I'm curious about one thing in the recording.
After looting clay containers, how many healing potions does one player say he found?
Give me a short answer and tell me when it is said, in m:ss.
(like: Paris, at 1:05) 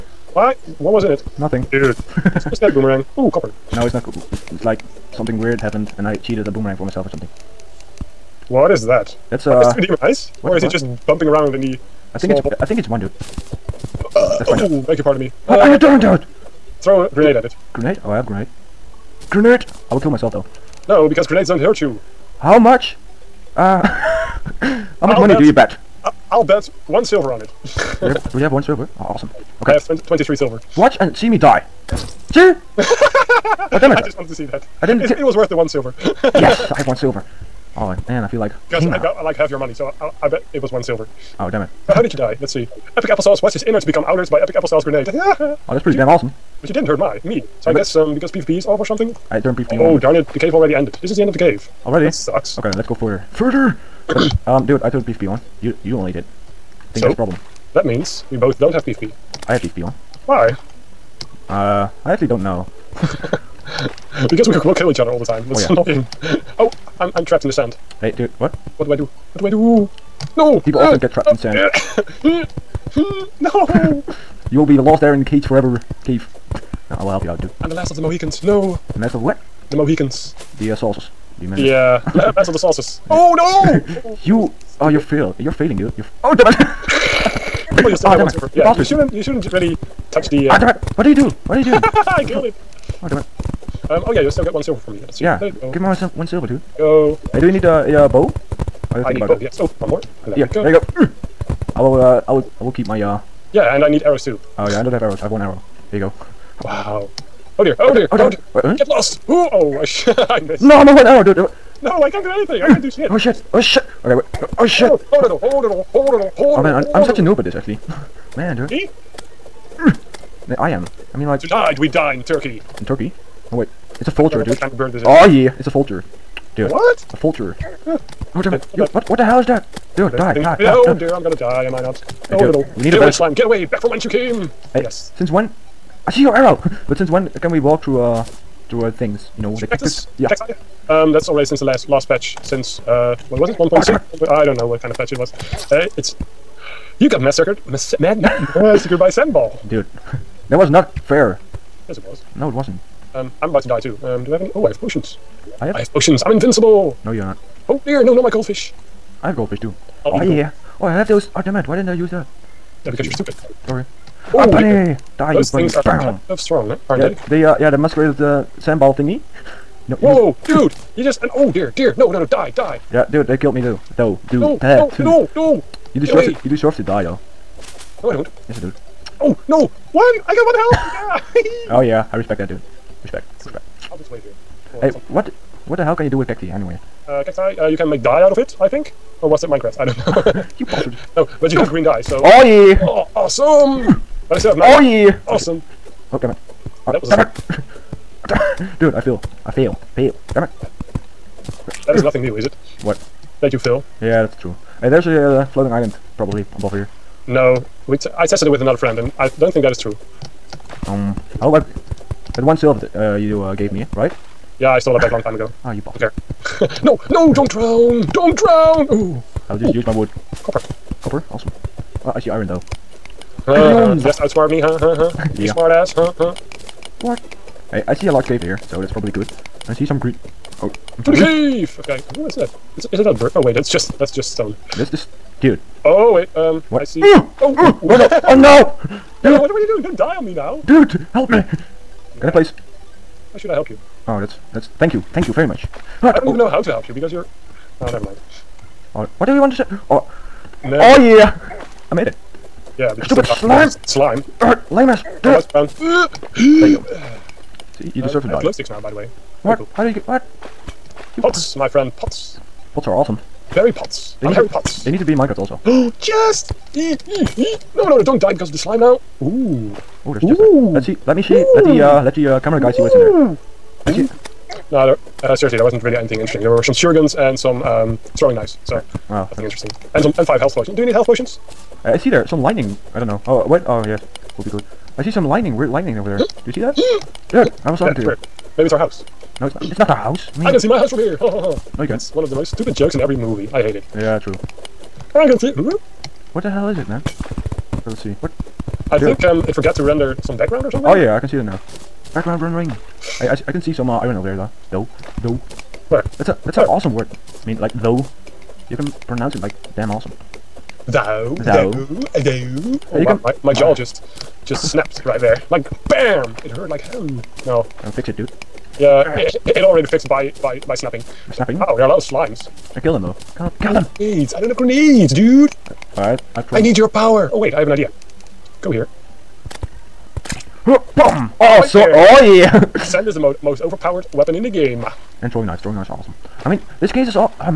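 5, at 4:40.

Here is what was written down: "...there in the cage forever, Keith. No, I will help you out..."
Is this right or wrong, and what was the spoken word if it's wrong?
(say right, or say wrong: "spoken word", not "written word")
right.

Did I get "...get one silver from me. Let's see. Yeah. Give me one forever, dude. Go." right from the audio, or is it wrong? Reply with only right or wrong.
wrong.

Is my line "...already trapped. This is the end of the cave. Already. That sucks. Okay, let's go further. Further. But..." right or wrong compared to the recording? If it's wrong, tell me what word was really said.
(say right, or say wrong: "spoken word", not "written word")
wrong: "ended", not "trapped".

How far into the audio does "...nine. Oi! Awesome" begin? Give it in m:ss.
3:14.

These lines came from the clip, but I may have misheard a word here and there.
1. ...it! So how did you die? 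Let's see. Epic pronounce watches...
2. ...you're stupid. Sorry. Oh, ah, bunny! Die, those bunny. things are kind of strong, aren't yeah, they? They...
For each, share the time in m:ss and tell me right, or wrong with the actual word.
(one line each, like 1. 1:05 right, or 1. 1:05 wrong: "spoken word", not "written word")
1. 0:41 wrong: "applesauce", not "pronounce"
2. 2:43 right.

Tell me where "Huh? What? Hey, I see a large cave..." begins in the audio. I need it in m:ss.
3:46.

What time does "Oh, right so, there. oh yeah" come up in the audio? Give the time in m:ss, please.
5:30.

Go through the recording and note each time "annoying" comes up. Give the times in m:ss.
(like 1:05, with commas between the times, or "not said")
1:05.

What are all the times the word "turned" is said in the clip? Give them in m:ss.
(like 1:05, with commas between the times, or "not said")
0:49, 0:54.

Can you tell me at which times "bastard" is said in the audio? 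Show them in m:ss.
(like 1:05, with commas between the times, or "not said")
1:28, 3:10.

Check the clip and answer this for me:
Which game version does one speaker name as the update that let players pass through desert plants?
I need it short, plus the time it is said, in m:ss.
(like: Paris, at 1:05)
1.6, at 2:23.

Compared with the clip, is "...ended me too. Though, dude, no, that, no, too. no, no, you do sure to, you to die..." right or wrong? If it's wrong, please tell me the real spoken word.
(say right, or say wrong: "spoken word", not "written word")
wrong: "killed", not "ended".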